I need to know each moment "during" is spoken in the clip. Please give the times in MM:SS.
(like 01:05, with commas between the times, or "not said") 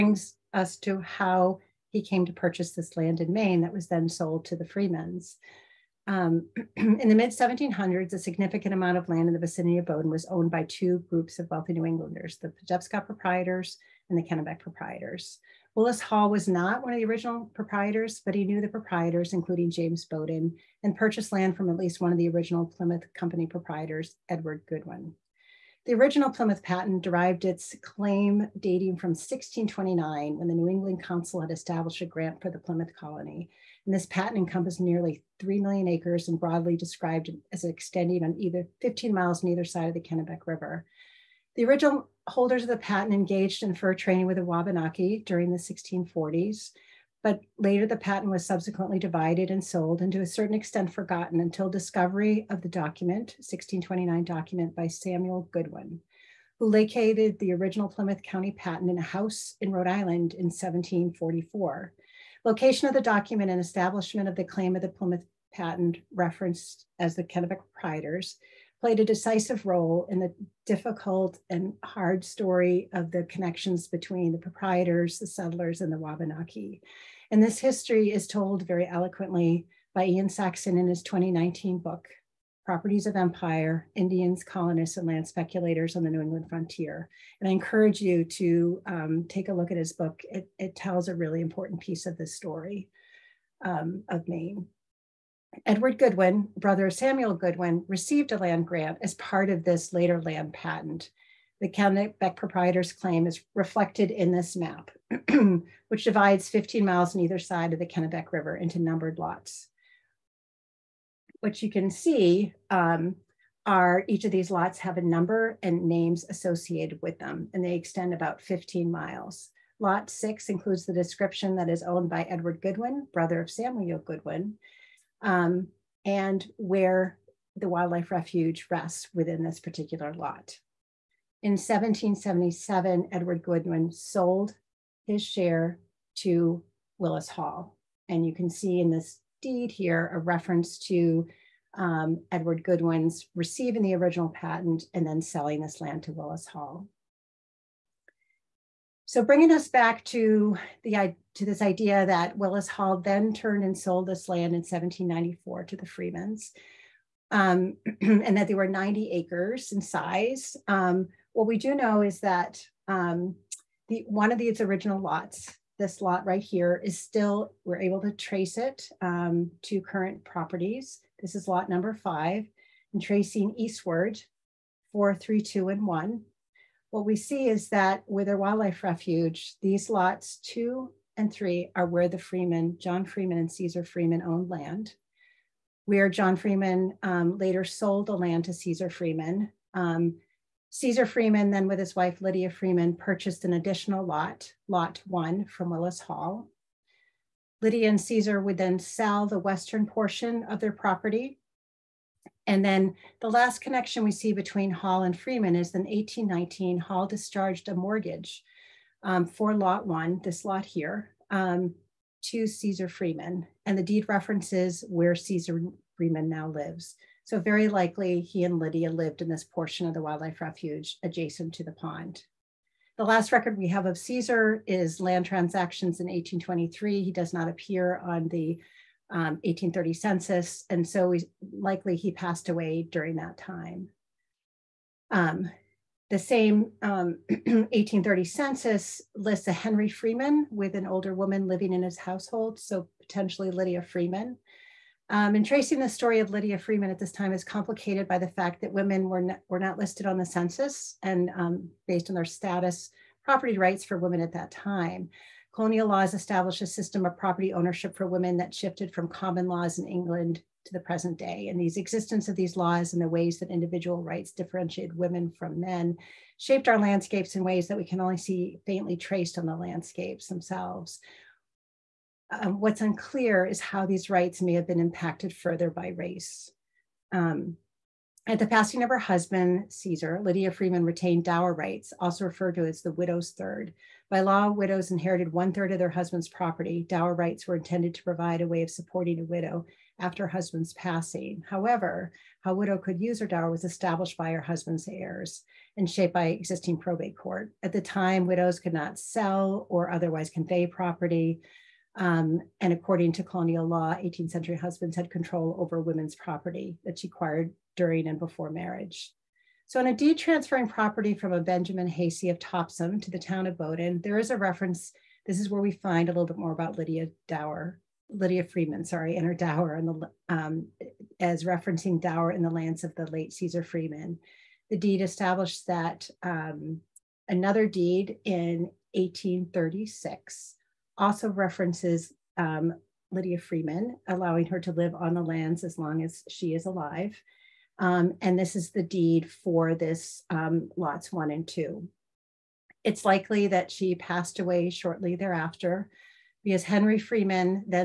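00:45, 03:52, 05:07.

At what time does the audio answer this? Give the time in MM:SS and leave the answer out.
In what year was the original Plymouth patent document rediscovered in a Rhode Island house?
01:00.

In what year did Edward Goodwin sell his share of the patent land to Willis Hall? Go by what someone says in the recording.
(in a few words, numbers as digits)
1777.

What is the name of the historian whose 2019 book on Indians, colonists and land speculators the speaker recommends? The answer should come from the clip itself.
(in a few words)
Ian Saxine.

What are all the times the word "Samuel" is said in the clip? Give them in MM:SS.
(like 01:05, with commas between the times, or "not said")
00:54, 01:36, 02:03.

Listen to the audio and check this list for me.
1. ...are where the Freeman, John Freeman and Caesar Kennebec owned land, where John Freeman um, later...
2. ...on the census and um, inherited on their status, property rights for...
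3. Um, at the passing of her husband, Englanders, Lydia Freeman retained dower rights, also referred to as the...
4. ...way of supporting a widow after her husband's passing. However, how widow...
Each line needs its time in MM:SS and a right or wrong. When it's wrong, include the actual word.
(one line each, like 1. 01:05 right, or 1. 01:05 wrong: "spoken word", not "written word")
1. 03:01 wrong: "Freeman", not "Kennebec"
2. 04:10 wrong: "based", not "inherited"
3. 04:37 wrong: "Caesar", not "Englanders"
4. 04:48 right.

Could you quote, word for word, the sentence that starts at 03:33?
And the deed references where Caesar Freeman now lives.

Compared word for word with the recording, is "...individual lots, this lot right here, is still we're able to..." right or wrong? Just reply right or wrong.
wrong.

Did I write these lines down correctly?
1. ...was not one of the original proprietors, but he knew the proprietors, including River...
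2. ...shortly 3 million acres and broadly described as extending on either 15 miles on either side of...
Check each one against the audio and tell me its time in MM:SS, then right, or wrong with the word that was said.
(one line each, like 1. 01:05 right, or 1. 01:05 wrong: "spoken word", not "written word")
1. 00:16 wrong: "James", not "River"
2. 00:34 wrong: "nearly", not "shortly".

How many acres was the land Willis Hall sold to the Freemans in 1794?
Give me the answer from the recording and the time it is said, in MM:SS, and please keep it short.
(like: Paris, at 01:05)
90, at 02:38.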